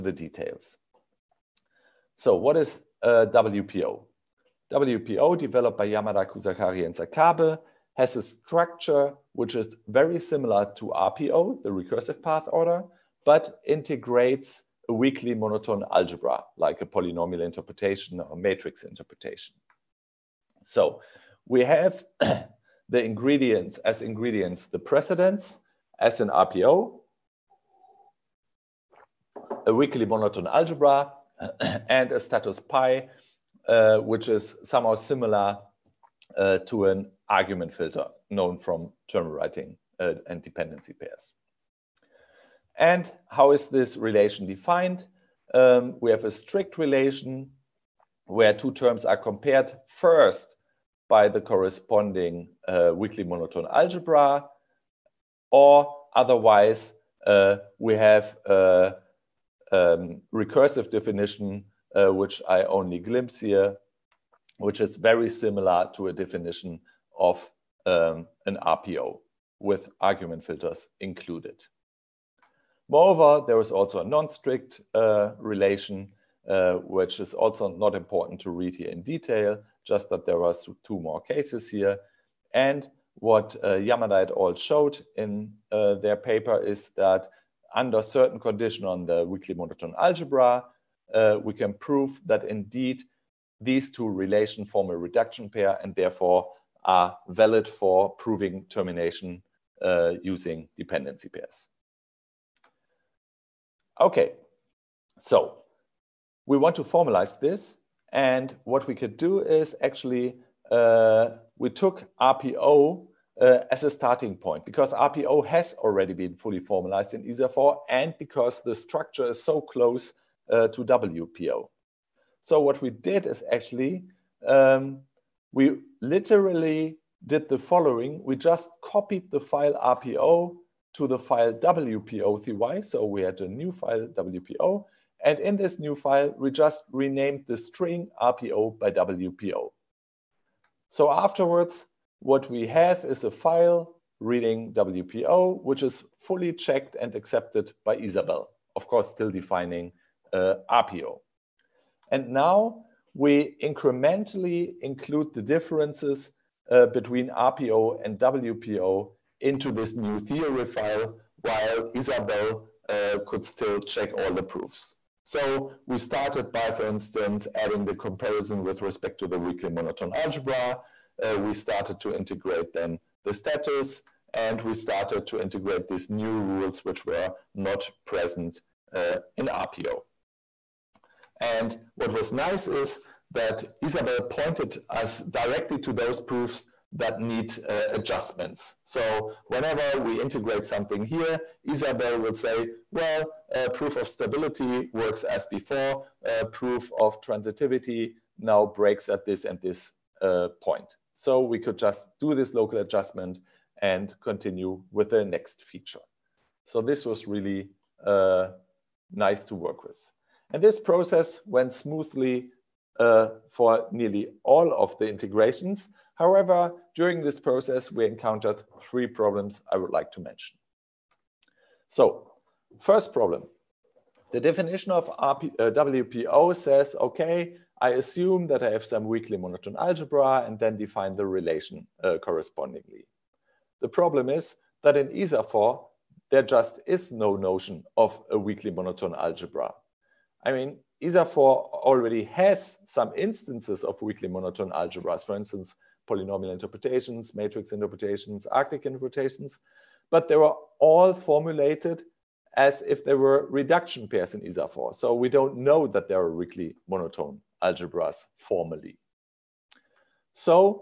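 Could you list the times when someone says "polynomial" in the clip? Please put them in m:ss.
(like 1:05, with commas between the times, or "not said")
0:16, 4:06.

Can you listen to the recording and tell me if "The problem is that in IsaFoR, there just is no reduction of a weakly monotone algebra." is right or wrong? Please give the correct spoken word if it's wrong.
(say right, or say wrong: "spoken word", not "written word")
wrong: "notion", not "reduction".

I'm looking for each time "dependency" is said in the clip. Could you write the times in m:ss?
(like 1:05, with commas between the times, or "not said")
0:40, 1:40.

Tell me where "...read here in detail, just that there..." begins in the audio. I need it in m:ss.
1:18.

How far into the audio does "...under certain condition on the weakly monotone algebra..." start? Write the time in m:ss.
1:27.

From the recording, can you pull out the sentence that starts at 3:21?
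So we could just do this local adjustment and continue with the next feature.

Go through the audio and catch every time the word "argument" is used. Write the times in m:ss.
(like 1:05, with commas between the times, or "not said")
0:37, 1:10.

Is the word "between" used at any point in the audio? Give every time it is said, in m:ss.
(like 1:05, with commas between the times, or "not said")
2:36.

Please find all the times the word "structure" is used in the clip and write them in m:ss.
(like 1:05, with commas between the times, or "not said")
0:08, 1:58.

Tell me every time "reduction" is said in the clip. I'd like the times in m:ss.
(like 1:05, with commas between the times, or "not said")
1:34, 4:13.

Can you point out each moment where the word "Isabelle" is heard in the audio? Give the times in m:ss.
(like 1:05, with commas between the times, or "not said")
2:27, 2:41, 3:03, 3:11.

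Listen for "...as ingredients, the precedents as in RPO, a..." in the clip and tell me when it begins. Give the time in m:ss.
0:23.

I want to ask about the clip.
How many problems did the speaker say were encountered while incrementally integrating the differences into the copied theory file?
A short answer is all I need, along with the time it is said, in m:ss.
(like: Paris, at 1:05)
3, at 3:38.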